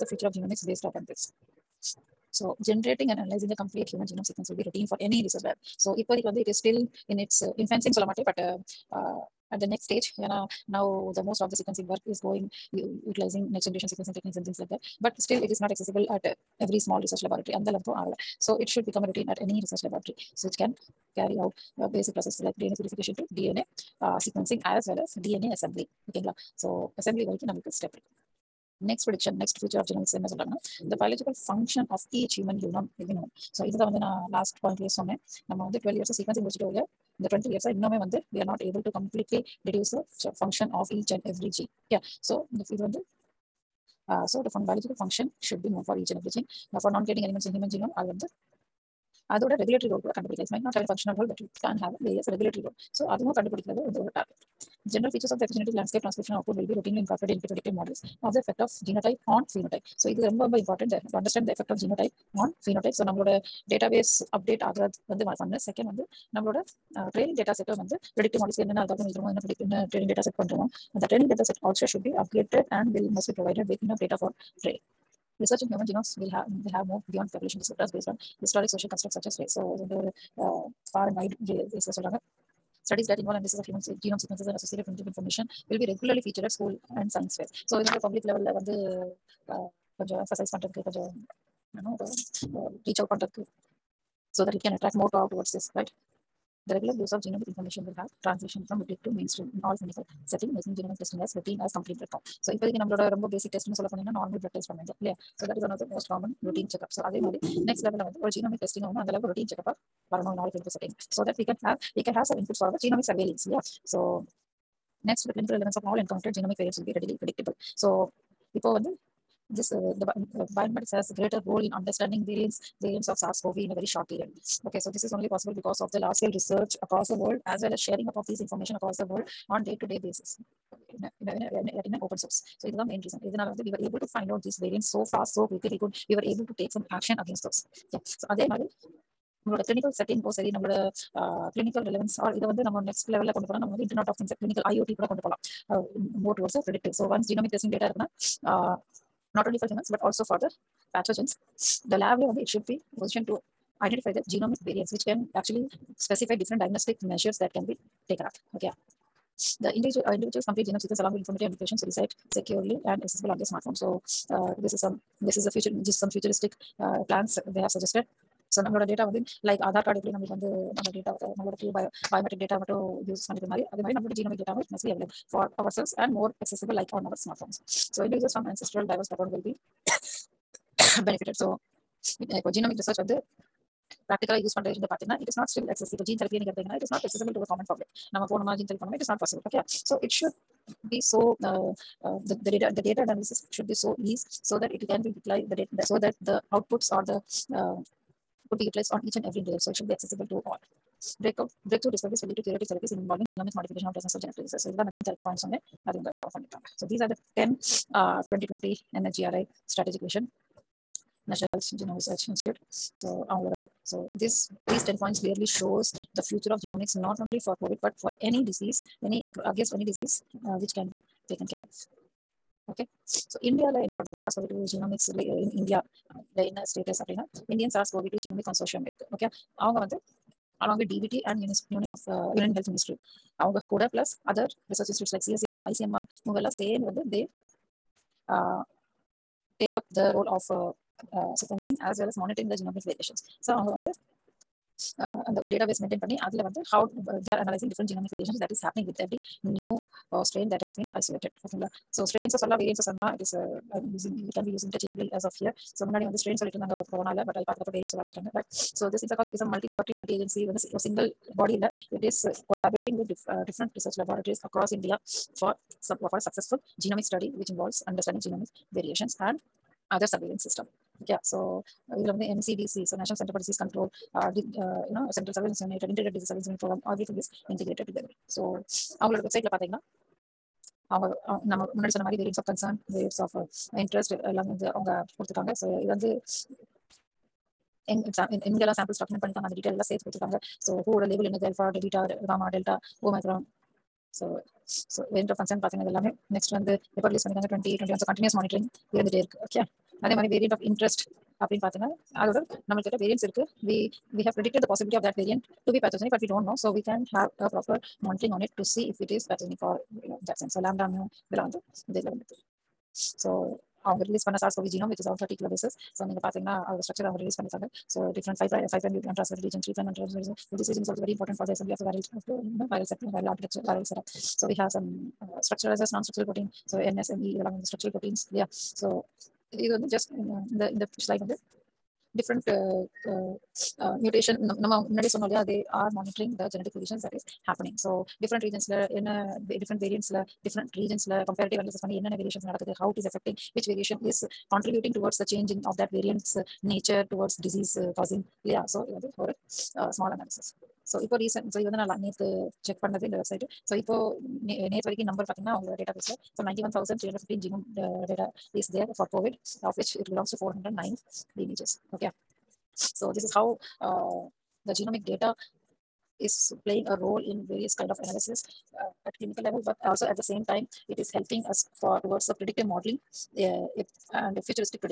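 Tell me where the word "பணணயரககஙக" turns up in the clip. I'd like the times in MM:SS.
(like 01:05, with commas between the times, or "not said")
04:49, 04:57.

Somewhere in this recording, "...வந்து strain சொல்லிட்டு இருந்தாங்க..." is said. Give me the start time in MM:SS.
04:16.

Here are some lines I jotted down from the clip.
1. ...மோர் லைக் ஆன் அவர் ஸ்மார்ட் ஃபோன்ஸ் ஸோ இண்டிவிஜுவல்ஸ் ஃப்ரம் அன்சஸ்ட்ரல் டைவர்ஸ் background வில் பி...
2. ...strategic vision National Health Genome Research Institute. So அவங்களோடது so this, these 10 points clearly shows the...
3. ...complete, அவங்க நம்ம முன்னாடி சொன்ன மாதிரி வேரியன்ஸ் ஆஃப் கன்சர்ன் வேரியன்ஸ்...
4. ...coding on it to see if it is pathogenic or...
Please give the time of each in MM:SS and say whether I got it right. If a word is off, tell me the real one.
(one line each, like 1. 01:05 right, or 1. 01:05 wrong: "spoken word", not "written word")
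1. 02:56 right
2. 03:29 right
3. 04:39 wrong: "website", not "complete"
4. 05:08 wrong: "monitoring", not "coding".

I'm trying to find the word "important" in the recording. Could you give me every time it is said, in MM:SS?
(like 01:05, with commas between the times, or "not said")
01:00, 05:21.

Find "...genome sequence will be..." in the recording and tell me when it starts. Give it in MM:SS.
00:04.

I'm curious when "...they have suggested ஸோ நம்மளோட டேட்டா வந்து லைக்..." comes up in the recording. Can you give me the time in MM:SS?
02:47.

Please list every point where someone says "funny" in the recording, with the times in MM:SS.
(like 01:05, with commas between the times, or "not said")
04:06.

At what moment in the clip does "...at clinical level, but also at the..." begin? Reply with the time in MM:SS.
06:09.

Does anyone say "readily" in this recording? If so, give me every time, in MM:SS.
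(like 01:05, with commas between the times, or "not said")
01:56.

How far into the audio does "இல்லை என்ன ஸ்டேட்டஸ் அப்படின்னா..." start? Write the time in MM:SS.
03:46.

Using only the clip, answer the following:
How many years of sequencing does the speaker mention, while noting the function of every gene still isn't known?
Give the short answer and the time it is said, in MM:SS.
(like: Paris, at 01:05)
12, at 00:35.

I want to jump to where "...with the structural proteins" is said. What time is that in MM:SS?
05:27.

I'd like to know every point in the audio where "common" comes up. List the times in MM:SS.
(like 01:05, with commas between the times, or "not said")
01:46, 03:07.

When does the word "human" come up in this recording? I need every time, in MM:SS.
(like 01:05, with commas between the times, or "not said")
00:03, 00:32, 00:47, 01:15, 01:23, 02:29.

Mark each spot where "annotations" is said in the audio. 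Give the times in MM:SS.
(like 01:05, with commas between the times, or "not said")
02:41.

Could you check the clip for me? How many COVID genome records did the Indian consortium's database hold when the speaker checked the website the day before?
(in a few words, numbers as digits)
91,315.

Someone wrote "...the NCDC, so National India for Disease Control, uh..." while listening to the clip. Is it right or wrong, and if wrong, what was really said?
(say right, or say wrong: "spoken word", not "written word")
wrong: "Center", not "India".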